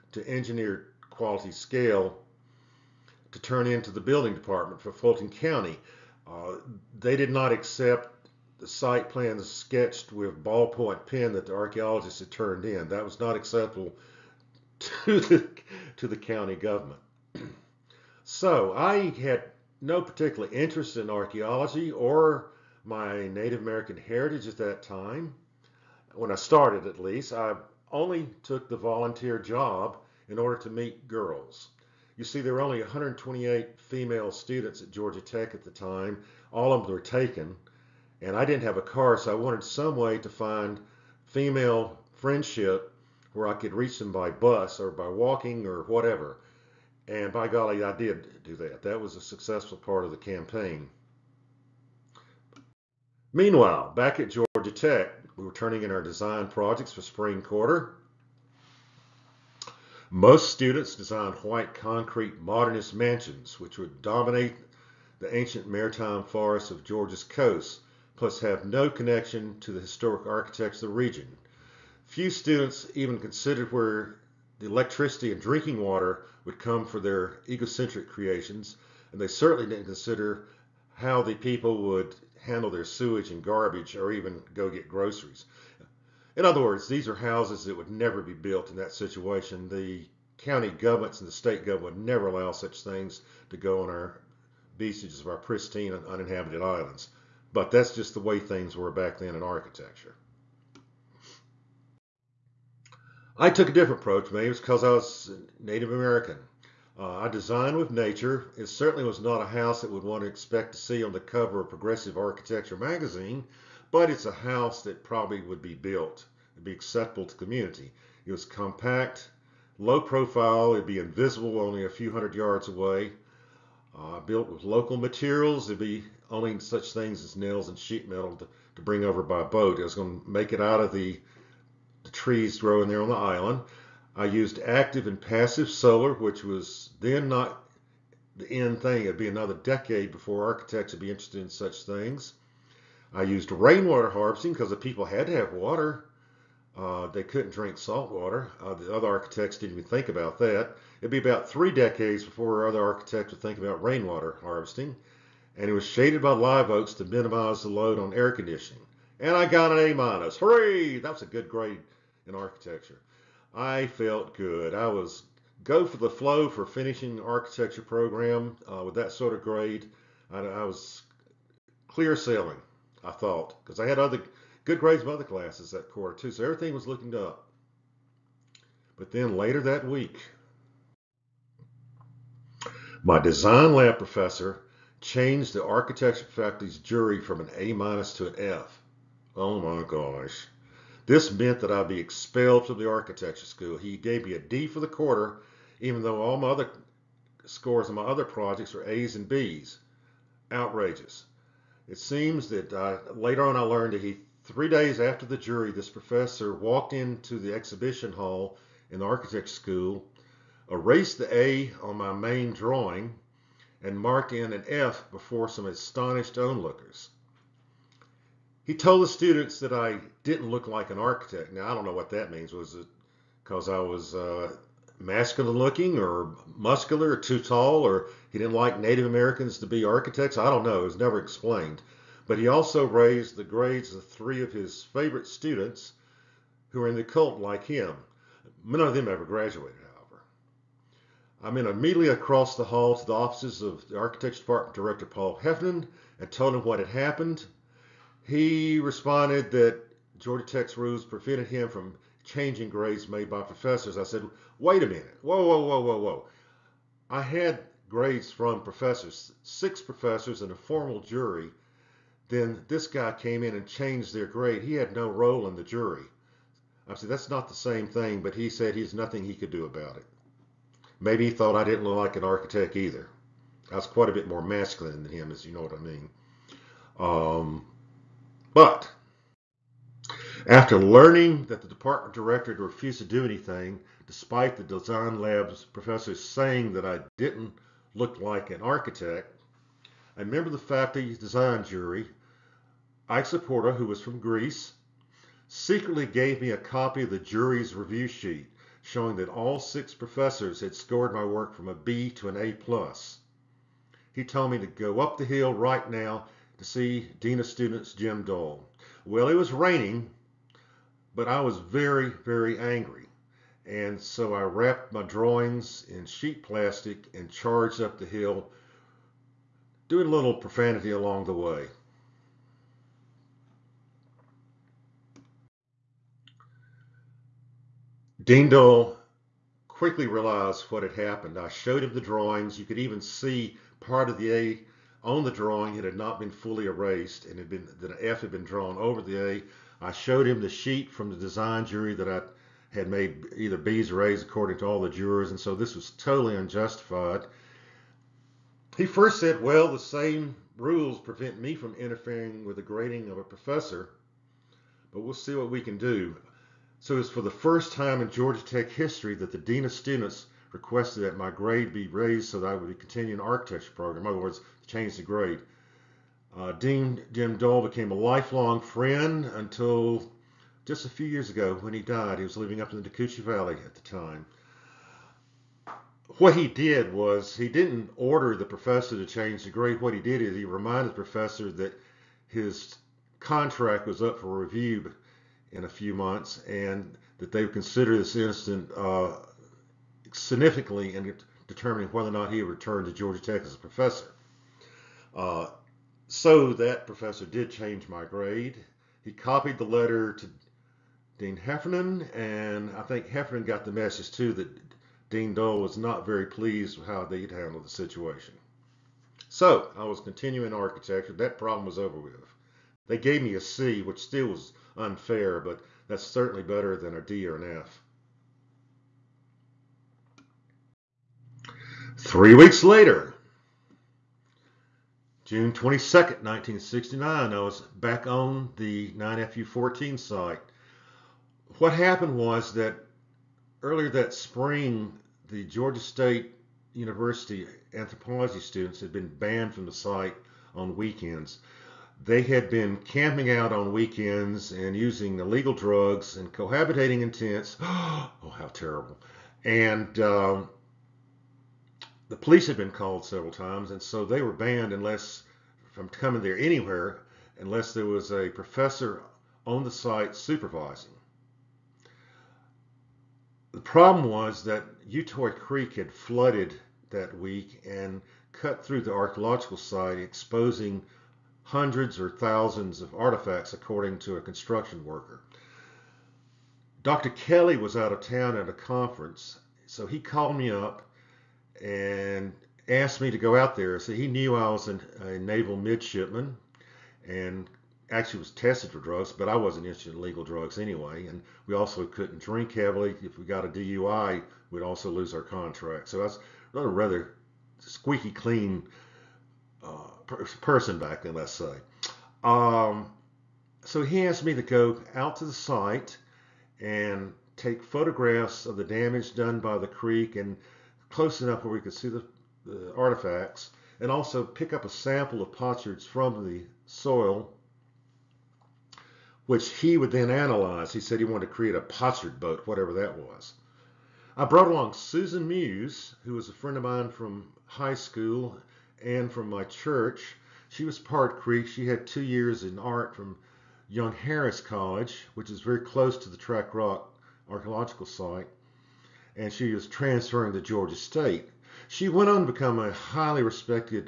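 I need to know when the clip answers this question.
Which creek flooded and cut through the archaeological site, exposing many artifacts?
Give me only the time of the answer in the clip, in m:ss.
7:44.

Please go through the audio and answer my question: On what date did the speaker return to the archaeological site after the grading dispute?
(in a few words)
June 22, 1969.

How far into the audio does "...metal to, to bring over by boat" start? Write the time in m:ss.
2:08.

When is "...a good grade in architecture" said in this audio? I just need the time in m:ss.
2:41.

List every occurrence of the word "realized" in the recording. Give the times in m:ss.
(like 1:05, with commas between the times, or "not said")
5:30.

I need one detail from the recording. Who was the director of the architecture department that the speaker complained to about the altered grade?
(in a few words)
Paul Heffernan.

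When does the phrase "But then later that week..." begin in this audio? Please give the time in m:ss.
2:58.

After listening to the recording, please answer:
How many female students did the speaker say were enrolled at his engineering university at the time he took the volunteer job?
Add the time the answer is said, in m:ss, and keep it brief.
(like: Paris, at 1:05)
128, at 0:32.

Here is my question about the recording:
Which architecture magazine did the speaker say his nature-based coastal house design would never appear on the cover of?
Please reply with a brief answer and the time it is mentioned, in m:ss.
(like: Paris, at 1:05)
Progressive Architecture, at 1:51.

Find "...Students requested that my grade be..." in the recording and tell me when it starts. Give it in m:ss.
5:59.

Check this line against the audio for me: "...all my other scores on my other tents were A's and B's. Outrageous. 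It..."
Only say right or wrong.
wrong.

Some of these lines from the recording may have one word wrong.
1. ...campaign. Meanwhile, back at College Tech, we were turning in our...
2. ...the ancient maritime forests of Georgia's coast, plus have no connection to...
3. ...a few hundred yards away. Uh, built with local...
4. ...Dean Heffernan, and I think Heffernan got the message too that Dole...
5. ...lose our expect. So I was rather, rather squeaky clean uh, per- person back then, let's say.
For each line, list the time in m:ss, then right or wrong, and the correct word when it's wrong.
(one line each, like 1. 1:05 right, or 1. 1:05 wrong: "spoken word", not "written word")
1. 0:50 wrong: "Georgia", not "College"
2. 1:05 right
3. 2:01 right
4. 6:41 wrong: "Dean", not "Dole"
5. 8:14 wrong: "contract", not "expect".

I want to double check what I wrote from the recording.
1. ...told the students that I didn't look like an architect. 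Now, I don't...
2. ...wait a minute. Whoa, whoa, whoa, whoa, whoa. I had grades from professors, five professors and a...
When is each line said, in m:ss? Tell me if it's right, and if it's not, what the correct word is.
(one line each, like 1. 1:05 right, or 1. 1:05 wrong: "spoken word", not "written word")
1. 3:38 right
2. 4:14 wrong: "six", not "five".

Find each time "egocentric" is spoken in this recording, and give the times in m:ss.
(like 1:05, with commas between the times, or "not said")
1:17.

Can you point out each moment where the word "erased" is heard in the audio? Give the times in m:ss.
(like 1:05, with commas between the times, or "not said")
3:30, 5:36.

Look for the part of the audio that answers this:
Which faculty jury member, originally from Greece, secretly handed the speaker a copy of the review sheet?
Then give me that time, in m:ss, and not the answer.
4:53.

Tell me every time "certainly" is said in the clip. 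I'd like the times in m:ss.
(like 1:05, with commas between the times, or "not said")
1:19, 1:48, 6:56.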